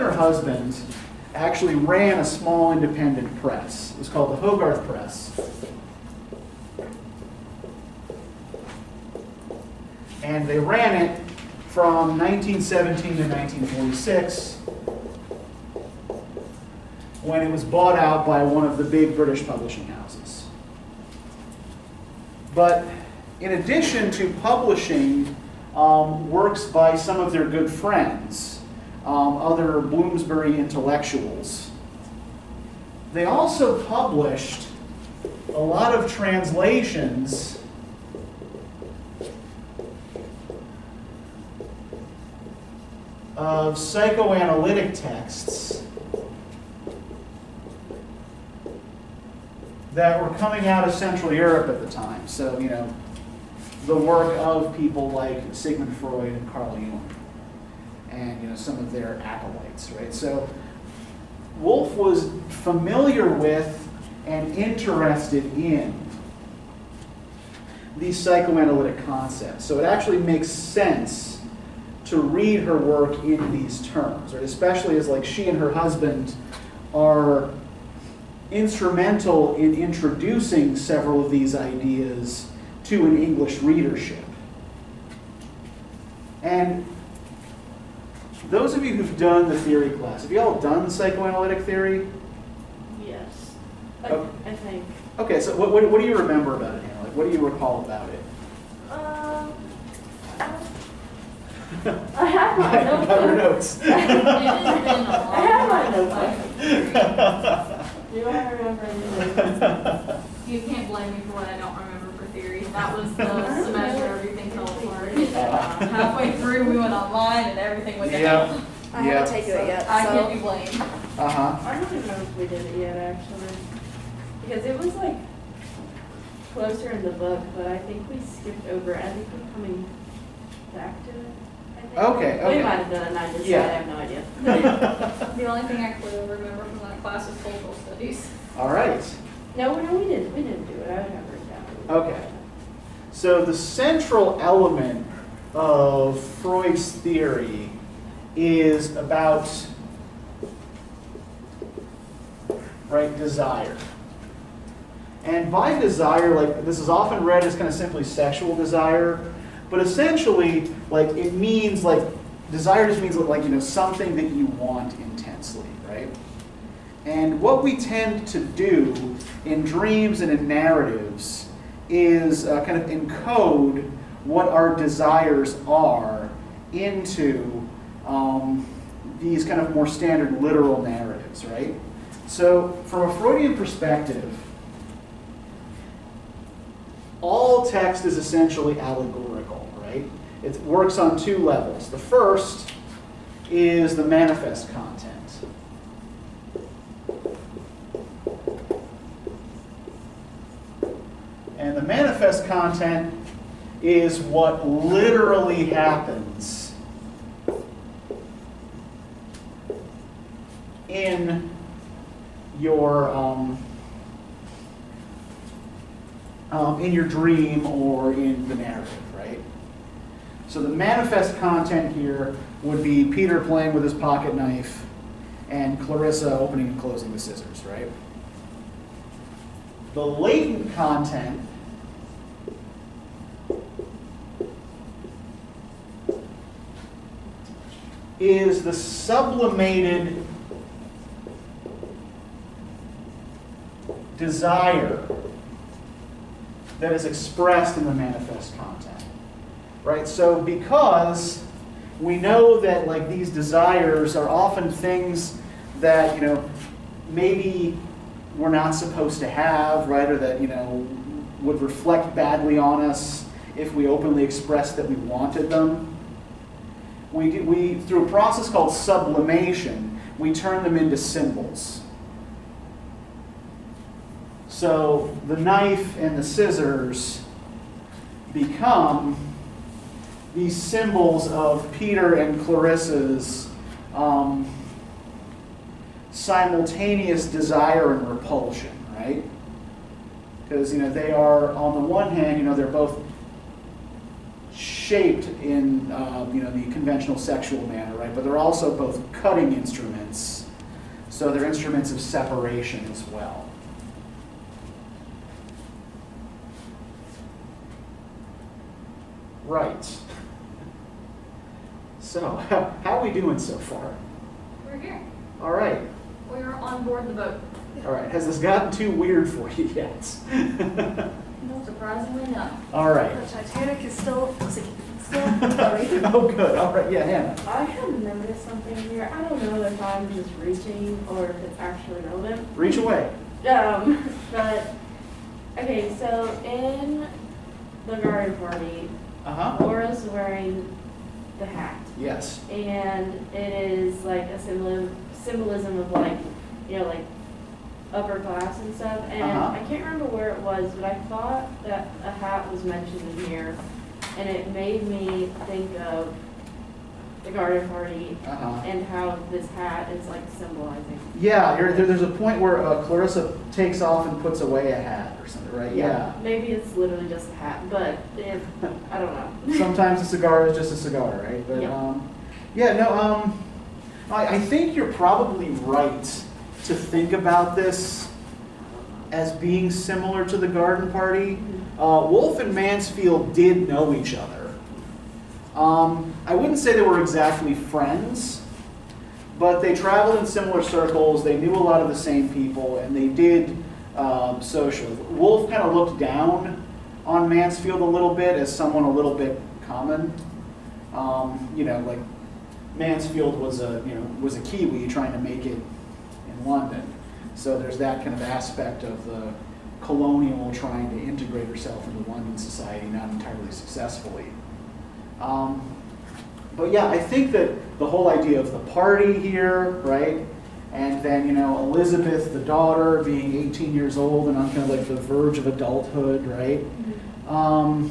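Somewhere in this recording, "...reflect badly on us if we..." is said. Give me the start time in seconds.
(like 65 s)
261 s.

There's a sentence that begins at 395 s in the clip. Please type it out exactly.
Woolf kind of looked down on Mansfield a little bit as someone a little bit common.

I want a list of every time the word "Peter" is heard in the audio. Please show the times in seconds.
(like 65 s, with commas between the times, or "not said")
223 s, 281 s.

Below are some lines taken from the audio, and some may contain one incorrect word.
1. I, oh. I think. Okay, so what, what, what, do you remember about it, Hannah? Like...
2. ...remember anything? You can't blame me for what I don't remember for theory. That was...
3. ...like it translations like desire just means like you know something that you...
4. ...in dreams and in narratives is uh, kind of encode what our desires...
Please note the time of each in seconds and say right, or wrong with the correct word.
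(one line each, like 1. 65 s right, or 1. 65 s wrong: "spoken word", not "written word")
1. 94 s right
2. 108 s right
3. 160 s wrong: "means", not "translations"
4. 169 s right.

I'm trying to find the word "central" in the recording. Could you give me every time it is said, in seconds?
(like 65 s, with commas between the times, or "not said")
50 s, 143 s.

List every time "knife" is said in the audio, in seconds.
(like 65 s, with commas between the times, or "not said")
224 s, 275 s.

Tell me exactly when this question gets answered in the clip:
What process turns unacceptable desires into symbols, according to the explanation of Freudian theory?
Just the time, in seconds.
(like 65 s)
268 s.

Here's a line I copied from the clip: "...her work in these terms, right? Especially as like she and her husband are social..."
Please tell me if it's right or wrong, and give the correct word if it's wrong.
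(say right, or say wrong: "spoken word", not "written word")
wrong: "instrumental", not "social".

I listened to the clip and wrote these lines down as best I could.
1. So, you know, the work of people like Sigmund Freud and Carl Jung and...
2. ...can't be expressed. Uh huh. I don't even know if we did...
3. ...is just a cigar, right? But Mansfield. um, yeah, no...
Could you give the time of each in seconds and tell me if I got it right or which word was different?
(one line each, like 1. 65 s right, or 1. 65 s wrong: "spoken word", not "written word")
1. 52 s right
2. 120 s wrong: "blamed", not "expressed"
3. 370 s wrong: "Yeah", not "Mansfield".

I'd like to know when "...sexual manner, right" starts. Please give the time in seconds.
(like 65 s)
297 s.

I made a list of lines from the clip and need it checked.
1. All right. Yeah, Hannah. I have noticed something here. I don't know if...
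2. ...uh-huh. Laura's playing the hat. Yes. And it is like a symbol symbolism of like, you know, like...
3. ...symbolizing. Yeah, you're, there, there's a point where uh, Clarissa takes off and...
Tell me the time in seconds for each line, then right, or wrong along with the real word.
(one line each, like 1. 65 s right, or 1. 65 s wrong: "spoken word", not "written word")
1. 326 s right
2. 339 s wrong: "wearing", not "playing"
3. 360 s right.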